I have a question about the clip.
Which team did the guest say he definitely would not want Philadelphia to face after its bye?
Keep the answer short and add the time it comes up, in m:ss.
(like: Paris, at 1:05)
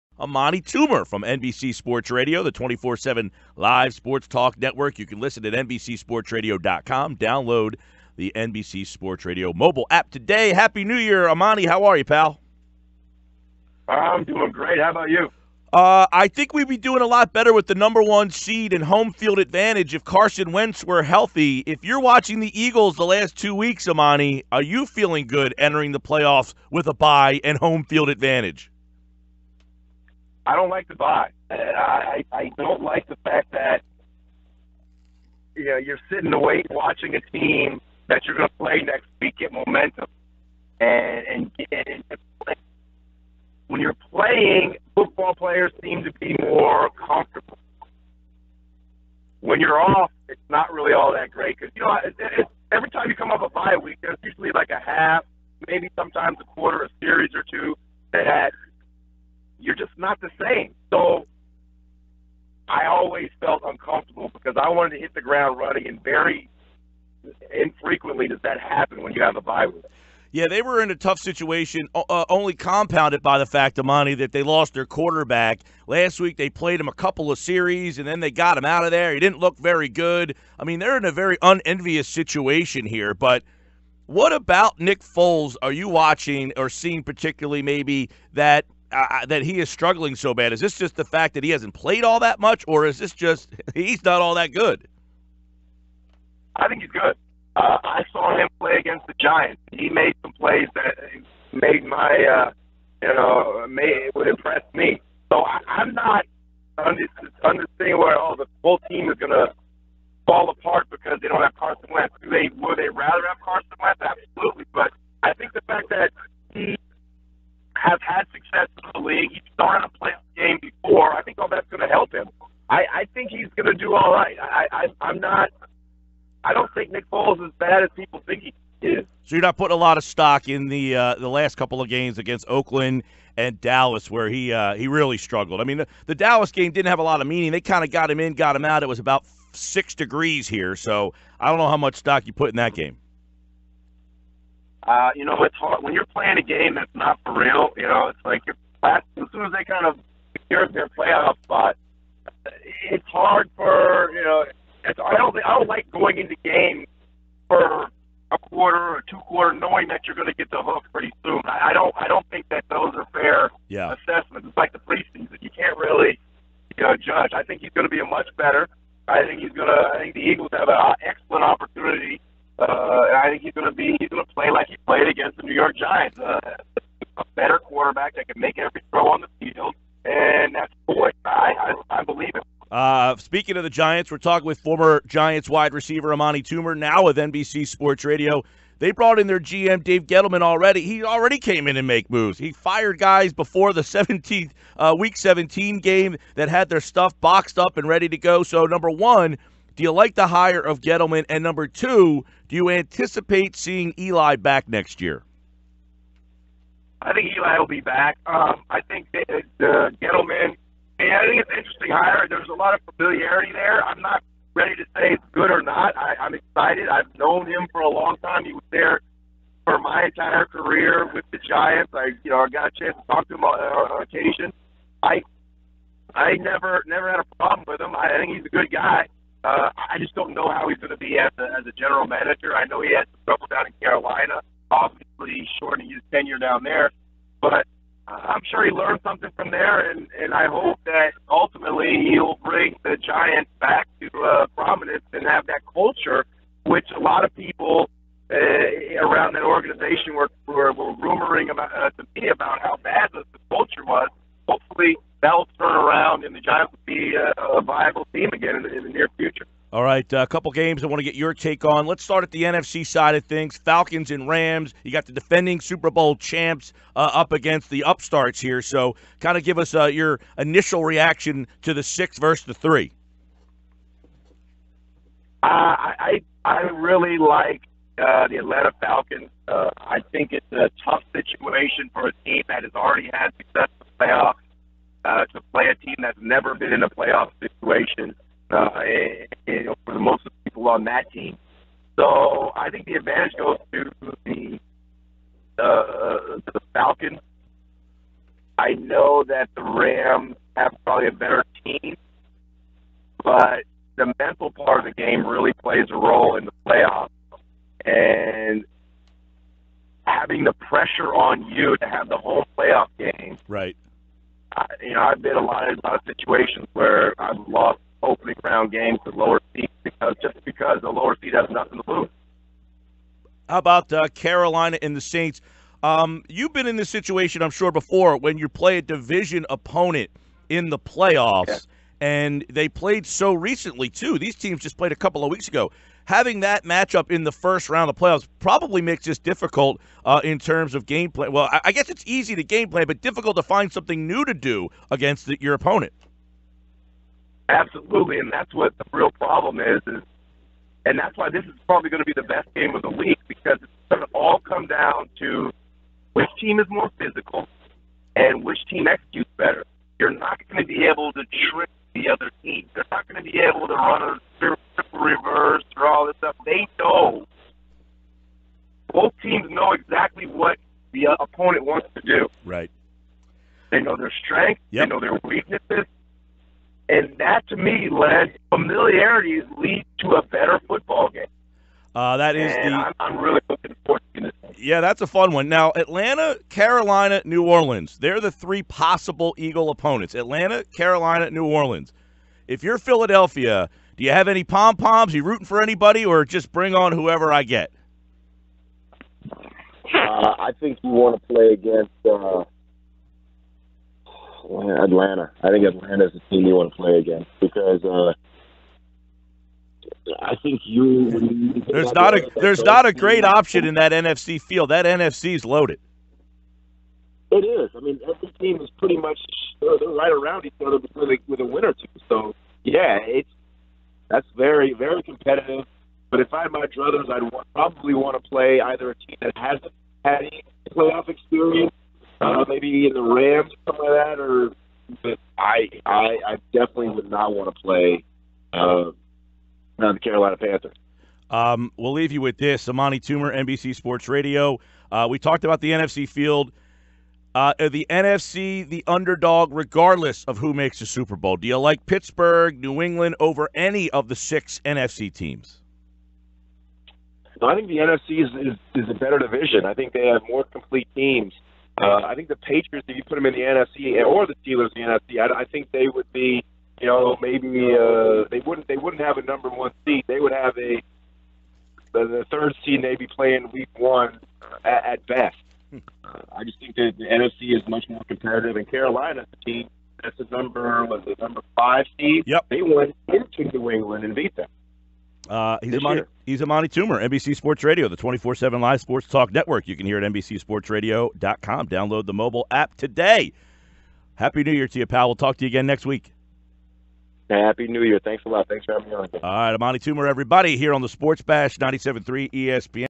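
Carolina Panthers, at 7:19.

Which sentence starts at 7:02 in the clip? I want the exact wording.
So yeah, it's that's very very competitive.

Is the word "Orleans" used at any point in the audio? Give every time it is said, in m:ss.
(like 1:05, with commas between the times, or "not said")
6:27, 6:31.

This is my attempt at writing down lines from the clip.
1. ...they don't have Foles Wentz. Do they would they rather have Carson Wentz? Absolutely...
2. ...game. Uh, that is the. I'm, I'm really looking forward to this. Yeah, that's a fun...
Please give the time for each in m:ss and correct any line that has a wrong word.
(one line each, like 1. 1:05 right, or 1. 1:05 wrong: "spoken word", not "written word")
1. 1:51 wrong: "Carson", not "Foles"
2. 6:21 right.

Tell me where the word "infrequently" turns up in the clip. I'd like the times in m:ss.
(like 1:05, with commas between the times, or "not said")
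1:07.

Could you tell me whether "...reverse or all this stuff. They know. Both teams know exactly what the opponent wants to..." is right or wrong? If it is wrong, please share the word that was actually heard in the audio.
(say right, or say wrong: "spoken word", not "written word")
right.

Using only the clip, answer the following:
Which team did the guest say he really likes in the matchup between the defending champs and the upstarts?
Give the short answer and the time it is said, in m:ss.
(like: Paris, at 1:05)
Atlanta Falcons, at 4:38.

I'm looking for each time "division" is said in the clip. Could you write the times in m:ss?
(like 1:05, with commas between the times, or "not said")
5:28, 7:39.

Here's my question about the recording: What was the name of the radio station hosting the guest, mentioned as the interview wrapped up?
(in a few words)
97.3 ESPN.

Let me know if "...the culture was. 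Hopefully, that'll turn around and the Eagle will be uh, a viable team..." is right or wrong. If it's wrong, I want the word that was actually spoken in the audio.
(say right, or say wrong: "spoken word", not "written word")
wrong: "Giants", not "Eagle".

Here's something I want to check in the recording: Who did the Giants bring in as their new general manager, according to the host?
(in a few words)
Dave Gettleman.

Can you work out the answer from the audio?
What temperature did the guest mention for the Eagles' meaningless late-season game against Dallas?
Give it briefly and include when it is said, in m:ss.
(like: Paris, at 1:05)
6 degrees, at 2:19.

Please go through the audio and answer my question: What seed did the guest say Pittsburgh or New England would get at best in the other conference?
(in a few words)
third seed.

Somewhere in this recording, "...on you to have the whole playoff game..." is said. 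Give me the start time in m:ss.
5:11.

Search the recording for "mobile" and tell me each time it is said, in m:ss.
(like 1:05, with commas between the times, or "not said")
0:09, 8:12.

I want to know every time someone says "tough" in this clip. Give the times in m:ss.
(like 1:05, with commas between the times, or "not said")
1:10, 4:40.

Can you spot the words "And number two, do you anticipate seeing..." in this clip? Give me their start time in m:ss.
3:21.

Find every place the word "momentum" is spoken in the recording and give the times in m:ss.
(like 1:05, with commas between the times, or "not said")
0:39.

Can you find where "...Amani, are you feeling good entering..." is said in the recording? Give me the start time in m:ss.
0:23.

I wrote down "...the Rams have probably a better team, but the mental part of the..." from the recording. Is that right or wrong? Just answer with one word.
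right.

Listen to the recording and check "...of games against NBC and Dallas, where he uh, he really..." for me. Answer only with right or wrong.
wrong.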